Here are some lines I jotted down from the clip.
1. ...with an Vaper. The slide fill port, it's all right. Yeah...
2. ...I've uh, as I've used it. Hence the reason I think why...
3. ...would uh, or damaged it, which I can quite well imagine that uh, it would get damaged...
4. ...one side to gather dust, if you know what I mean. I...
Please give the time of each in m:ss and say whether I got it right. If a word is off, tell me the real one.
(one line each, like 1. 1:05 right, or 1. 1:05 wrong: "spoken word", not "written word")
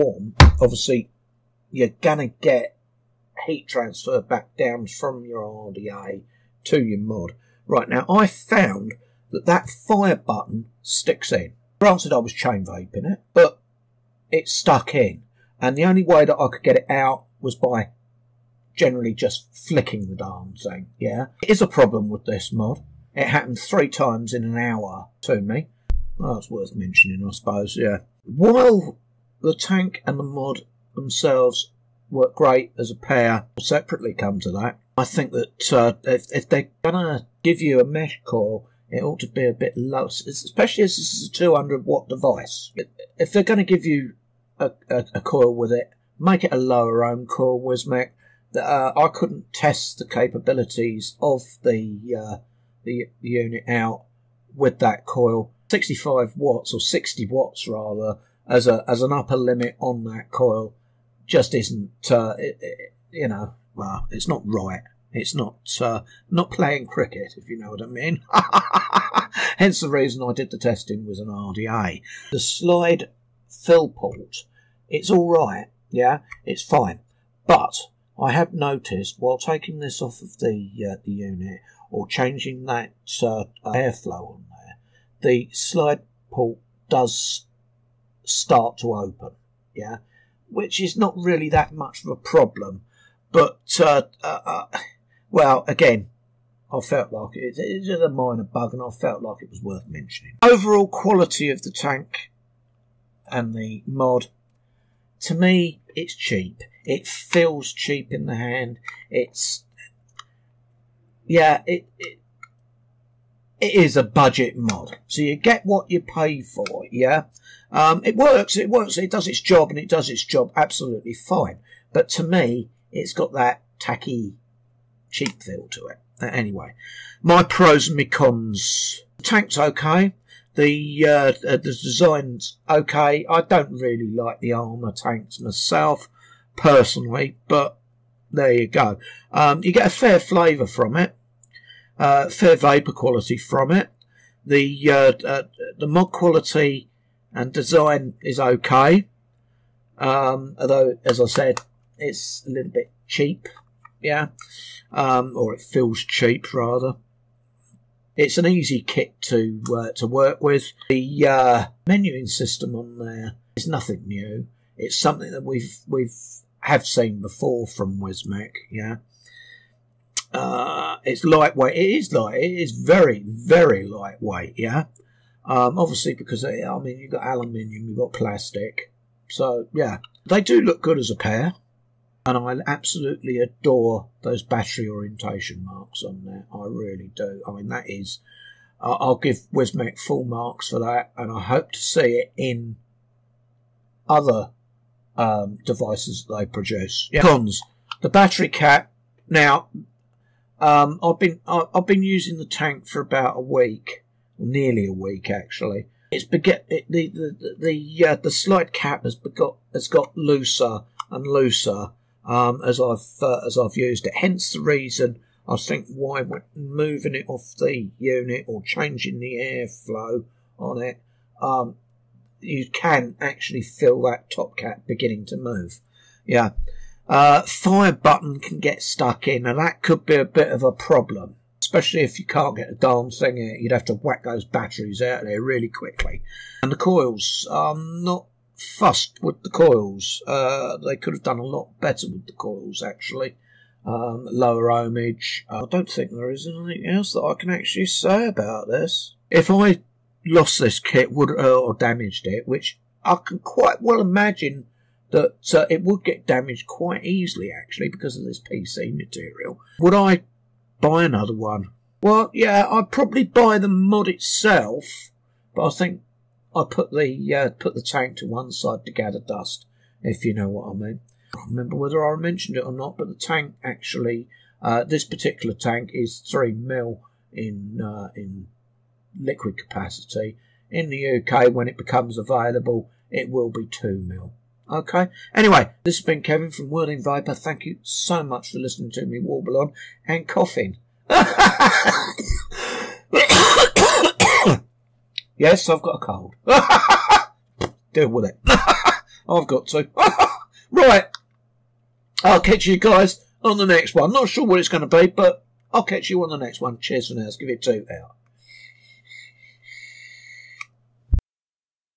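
1. 1:11 wrong: "RDA", not "Vaper"
2. 3:32 right
3. 4:11 right
4. 4:28 right.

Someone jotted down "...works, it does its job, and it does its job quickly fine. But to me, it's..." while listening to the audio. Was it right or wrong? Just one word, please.
wrong.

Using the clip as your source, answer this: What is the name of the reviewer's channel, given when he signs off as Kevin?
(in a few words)
Worthing Vaper.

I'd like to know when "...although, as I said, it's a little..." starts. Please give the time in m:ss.
2:30.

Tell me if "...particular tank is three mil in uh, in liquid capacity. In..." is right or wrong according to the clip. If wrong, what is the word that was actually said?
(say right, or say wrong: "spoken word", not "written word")
right.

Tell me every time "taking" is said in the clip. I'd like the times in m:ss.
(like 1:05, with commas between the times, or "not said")
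1:19.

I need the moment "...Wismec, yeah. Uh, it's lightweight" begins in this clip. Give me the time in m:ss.
2:47.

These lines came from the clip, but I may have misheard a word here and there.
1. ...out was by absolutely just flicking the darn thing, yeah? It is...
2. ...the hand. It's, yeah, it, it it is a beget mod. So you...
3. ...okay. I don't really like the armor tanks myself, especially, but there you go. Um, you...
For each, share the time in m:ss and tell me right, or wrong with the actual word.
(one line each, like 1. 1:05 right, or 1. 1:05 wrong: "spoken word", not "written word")
1. 0:16 wrong: "generally", not "absolutely"
2. 1:48 wrong: "budget", not "beget"
3. 2:12 wrong: "personally", not "especially".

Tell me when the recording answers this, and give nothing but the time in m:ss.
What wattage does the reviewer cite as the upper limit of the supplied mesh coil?
0:56.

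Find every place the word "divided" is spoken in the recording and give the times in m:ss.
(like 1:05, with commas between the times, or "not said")
not said.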